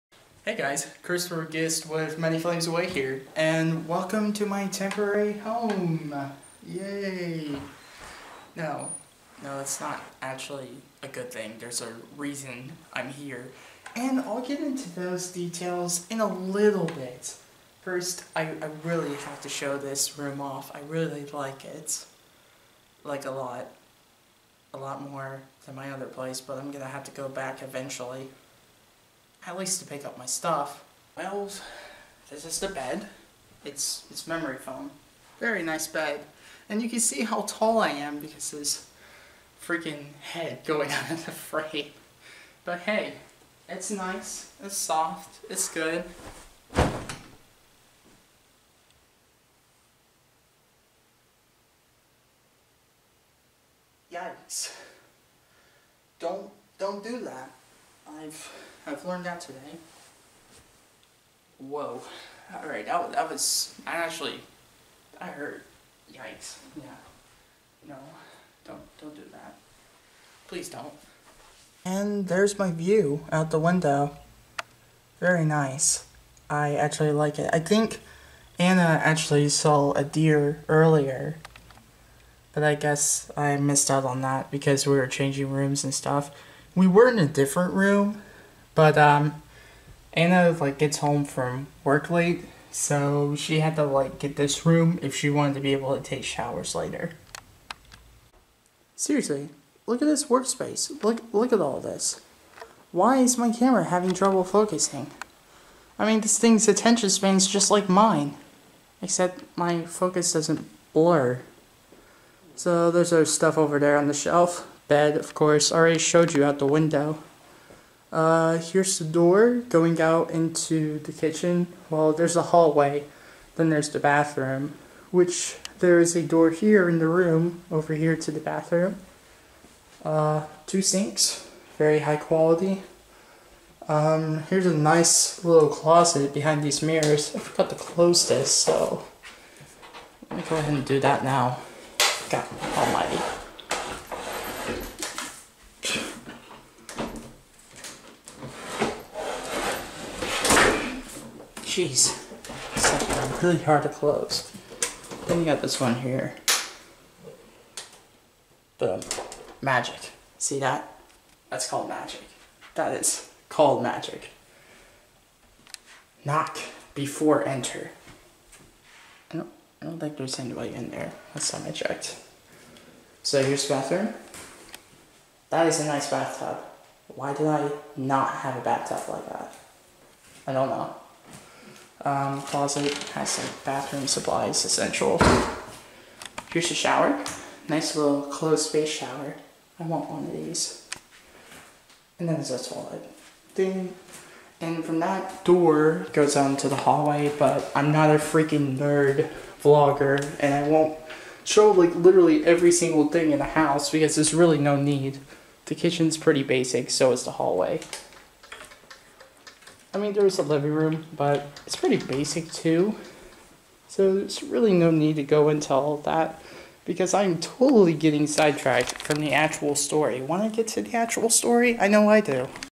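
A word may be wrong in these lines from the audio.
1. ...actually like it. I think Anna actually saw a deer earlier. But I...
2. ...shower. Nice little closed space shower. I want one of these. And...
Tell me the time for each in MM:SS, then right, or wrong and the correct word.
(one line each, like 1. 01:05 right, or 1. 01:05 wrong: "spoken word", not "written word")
1. 01:16 right
2. 03:06 right.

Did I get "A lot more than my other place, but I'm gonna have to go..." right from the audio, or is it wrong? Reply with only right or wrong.
right.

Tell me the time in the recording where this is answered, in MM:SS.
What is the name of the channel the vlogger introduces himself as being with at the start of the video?
00:02.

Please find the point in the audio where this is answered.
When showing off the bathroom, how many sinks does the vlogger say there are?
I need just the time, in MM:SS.
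02:10.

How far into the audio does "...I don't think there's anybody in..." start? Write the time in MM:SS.
02:49.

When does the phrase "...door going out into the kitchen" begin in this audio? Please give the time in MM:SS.
01:59.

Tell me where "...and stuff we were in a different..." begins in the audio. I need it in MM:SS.
01:25.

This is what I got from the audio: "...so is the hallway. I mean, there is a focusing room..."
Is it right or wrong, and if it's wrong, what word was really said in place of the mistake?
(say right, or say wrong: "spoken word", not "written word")
wrong: "living", not "focusing".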